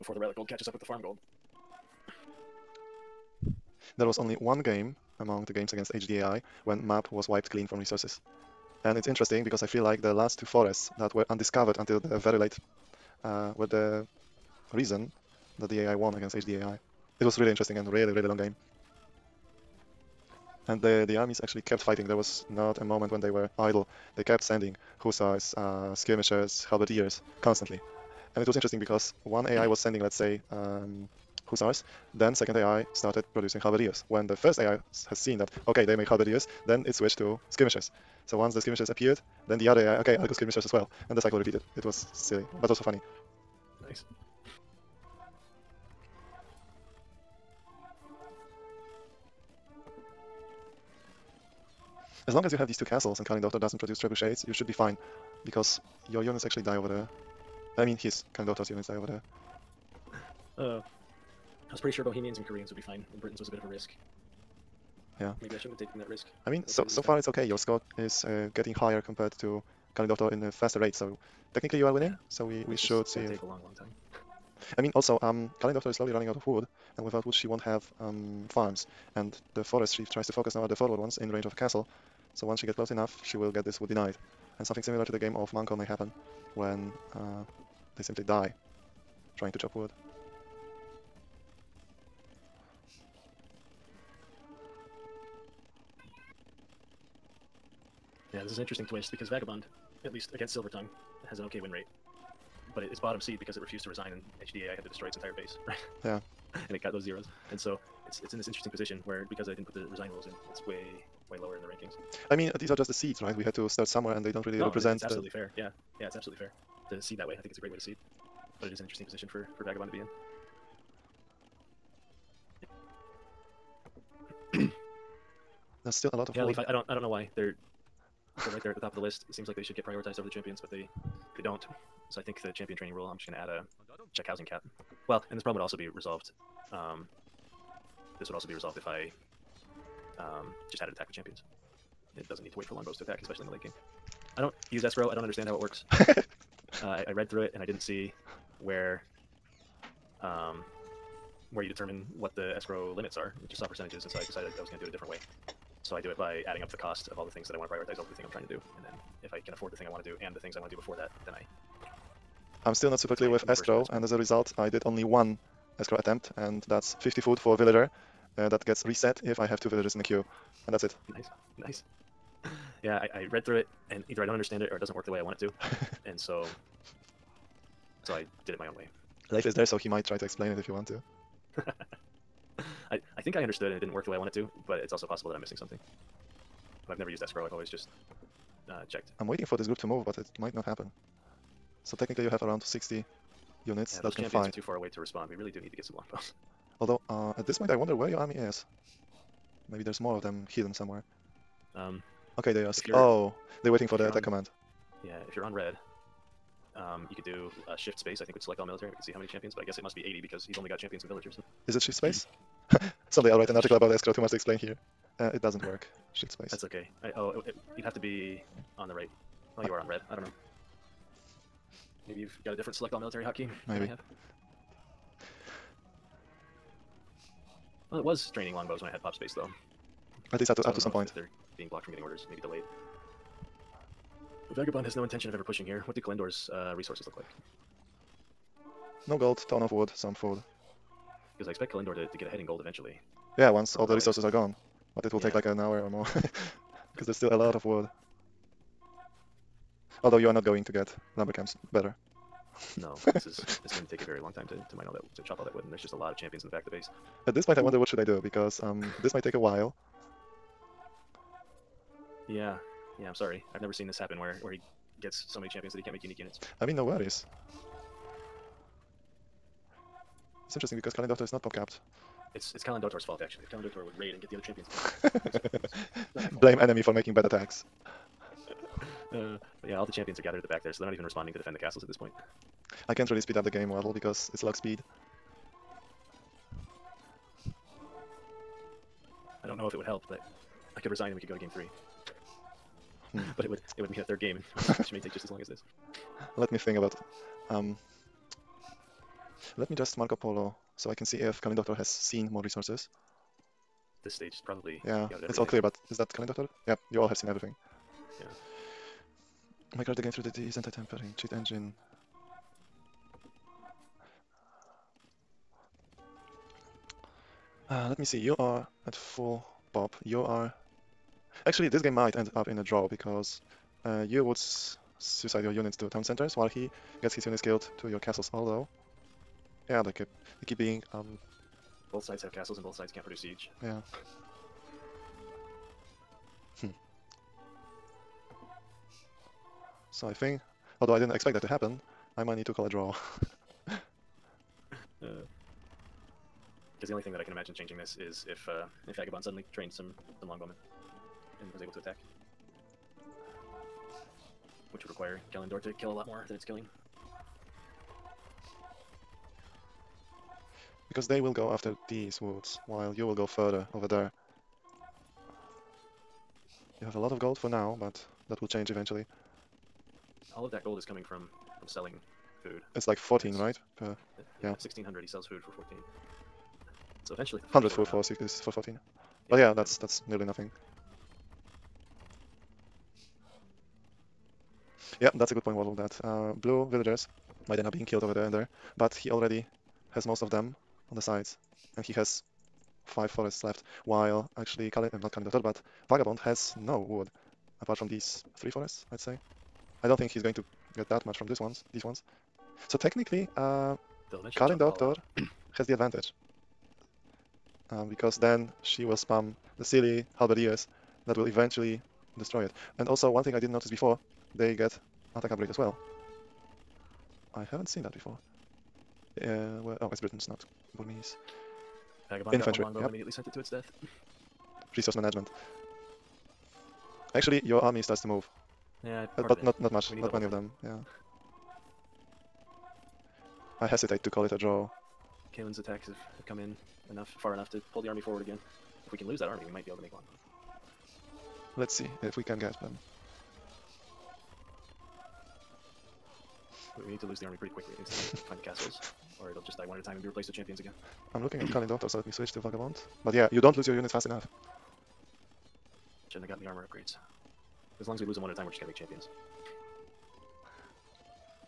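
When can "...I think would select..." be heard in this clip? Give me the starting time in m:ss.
3:28.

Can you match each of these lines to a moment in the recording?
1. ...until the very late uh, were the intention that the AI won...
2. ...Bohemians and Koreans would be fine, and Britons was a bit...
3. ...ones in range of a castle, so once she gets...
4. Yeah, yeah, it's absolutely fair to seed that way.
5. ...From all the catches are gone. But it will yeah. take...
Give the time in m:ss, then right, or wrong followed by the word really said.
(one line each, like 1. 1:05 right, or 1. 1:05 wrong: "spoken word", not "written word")
1. 0:11 wrong: "reason", not "intention"
2. 1:02 right
3. 1:20 right
4. 1:55 right
5. 4:03 wrong: "resources", not "catches".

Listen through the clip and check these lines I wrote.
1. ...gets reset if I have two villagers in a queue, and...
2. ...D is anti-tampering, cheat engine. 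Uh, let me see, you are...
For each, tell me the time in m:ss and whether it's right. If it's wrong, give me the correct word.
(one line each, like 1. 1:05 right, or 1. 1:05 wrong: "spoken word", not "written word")
1. 2:48 right
2. 5:10 right.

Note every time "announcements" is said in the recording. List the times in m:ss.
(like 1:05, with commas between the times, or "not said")
not said.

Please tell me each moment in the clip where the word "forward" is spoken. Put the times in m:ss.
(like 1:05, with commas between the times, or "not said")
1:20, 7:18.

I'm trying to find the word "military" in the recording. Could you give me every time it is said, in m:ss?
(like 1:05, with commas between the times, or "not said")
3:28, 3:42.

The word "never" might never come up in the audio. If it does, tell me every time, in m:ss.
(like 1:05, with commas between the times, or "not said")
3:06, 4:23.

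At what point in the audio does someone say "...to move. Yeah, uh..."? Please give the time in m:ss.
7:08.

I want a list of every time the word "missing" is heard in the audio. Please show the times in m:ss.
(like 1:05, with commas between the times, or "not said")
3:05.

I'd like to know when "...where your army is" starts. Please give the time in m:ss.
3:17.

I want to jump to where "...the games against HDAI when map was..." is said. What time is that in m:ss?
0:05.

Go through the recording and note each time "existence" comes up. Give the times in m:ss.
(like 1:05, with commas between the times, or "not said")
not said.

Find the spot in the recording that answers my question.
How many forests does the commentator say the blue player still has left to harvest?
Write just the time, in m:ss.
6:32.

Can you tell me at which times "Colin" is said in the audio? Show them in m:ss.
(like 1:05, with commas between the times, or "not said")
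5:01, 6:44.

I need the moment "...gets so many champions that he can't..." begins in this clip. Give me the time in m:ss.
4:25.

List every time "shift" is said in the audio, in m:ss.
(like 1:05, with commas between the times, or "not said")
3:27, 3:31, 3:36.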